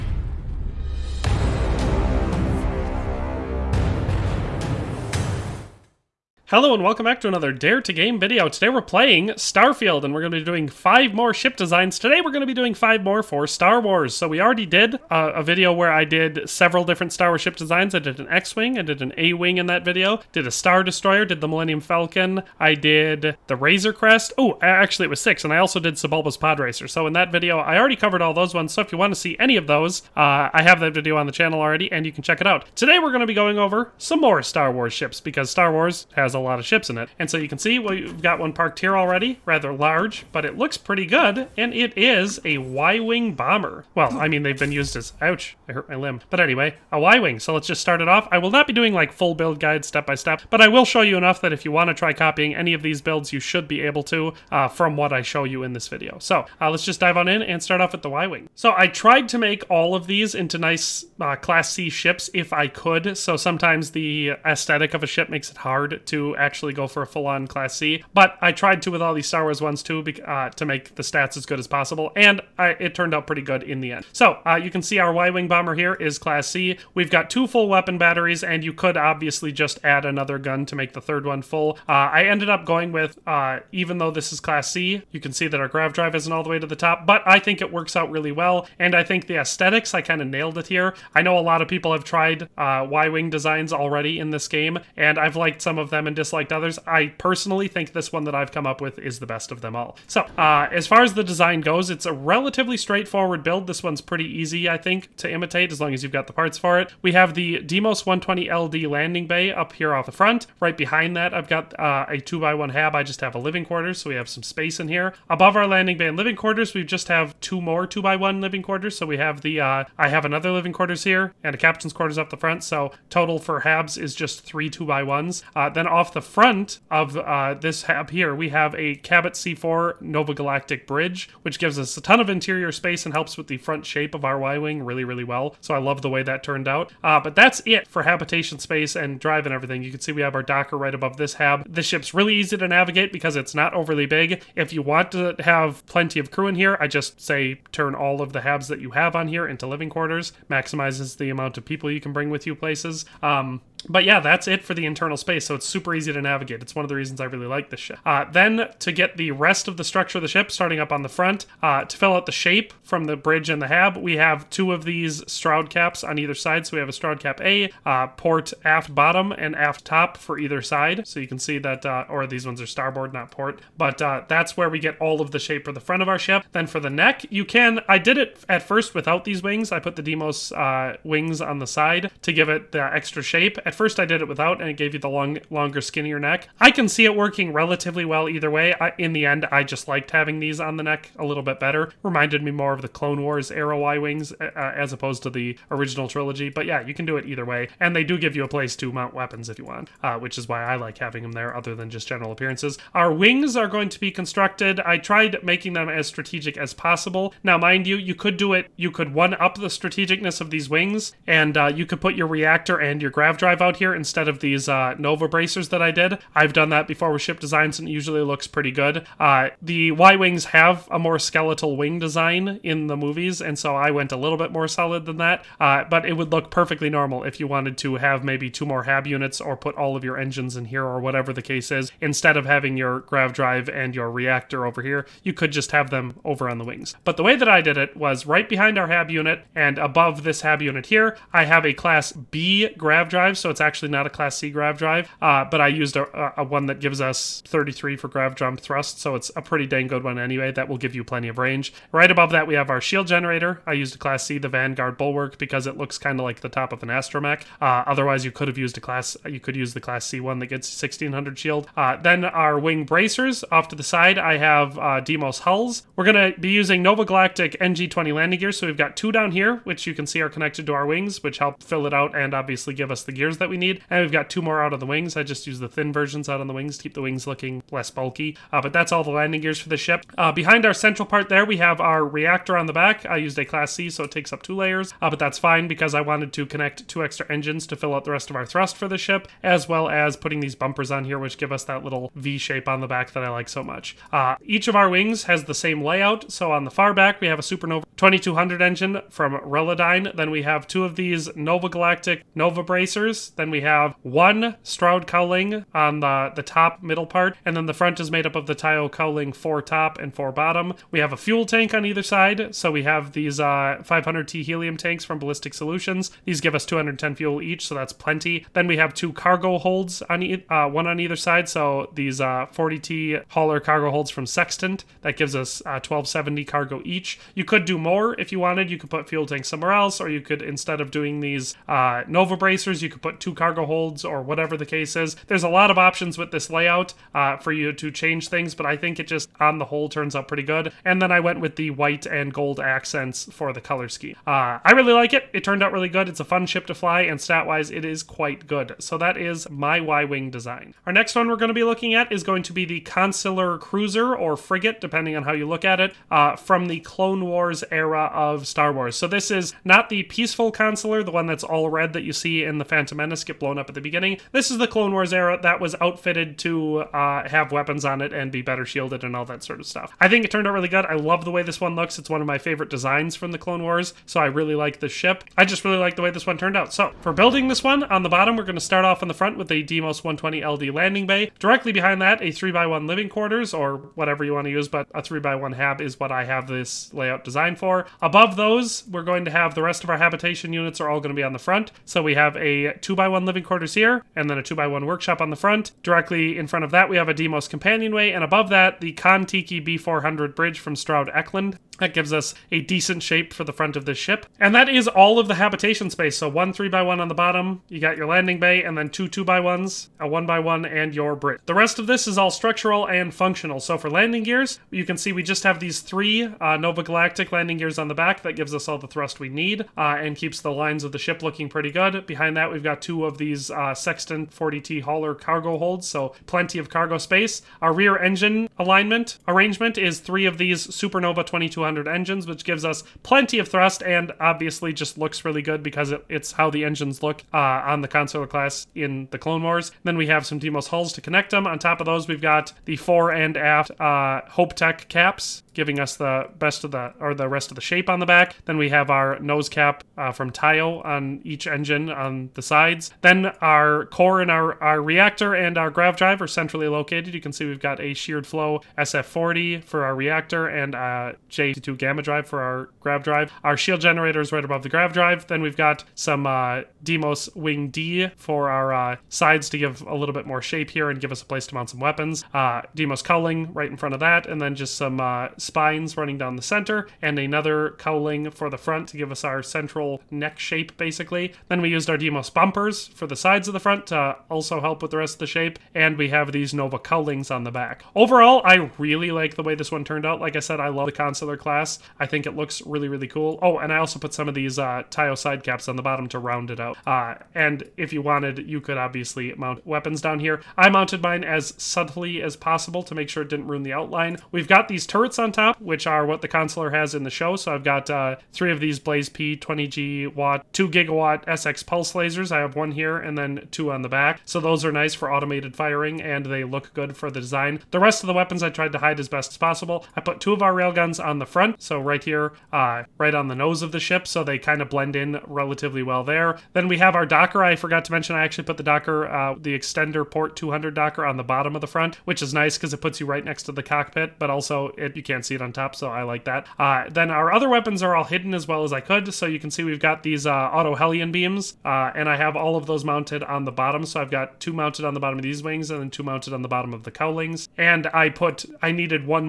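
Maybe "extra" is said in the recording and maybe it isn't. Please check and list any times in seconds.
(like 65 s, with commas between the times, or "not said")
182 s, 287 s.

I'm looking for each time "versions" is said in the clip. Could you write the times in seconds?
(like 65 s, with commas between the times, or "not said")
275 s.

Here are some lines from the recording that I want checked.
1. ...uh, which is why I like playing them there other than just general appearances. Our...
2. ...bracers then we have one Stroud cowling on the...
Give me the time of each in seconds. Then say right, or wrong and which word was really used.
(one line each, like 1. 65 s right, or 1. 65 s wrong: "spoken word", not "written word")
1. 200 s wrong: "having", not "playing"
2. 302 s right.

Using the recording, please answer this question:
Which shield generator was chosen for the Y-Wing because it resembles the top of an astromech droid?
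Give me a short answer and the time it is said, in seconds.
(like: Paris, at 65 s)
Vanguard Bulwark, at 254 s.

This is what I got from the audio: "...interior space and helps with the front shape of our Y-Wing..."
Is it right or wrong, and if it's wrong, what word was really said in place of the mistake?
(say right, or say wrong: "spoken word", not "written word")
right.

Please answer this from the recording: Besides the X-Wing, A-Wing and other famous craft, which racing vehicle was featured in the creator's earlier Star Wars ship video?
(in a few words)
Sebulba's Pod Racer.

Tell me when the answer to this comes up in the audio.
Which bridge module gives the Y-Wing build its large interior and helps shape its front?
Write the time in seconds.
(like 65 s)
128 s.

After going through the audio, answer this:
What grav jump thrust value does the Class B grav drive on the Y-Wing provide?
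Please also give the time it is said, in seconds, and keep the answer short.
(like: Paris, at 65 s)
33, at 247 s.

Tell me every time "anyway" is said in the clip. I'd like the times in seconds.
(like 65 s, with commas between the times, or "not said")
46 s, 250 s.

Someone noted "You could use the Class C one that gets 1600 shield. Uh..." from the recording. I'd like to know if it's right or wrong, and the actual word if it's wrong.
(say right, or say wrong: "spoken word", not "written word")
right.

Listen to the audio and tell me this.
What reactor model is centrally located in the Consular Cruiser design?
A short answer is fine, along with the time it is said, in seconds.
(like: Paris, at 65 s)
Sheared Flow SF40, at 457 s.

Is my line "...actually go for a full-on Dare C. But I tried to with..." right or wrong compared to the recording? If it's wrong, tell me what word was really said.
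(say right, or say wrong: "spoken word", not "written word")
wrong: "Class", not "Dare".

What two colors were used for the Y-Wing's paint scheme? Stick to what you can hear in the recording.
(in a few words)
White and gold.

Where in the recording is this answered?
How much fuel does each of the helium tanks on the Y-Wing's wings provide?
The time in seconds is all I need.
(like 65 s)
316 s.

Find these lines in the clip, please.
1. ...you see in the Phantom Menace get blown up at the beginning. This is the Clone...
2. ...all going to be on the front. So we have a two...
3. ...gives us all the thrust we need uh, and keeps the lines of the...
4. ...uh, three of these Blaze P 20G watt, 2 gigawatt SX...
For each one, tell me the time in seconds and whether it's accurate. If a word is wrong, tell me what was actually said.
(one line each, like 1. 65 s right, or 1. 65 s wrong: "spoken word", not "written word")
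1. 362 s right
2. 390 s right
3. 418 s right
4. 507 s right.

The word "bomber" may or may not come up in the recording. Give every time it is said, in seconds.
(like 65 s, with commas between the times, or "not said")
43 s, 75 s.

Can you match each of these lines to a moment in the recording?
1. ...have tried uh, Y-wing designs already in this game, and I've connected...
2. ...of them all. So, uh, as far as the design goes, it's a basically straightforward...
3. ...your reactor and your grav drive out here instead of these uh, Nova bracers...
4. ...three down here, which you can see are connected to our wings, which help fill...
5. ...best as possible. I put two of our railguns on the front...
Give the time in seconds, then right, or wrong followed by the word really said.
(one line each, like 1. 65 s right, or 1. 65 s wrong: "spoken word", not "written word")
1. 91 s wrong: "liked", not "connected"
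2. 99 s wrong: "relatively", not "basically"
3. 212 s right
4. 268 s wrong: "two", not "three"
5. 519 s right.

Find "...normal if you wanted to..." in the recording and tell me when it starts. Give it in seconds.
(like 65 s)
226 s.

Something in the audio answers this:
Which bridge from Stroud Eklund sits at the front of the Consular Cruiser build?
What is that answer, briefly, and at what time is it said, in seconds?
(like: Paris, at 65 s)
Kontiki B400, at 398 s.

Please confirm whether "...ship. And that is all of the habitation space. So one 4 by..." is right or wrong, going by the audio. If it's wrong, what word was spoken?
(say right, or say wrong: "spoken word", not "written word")
wrong: "3", not "4".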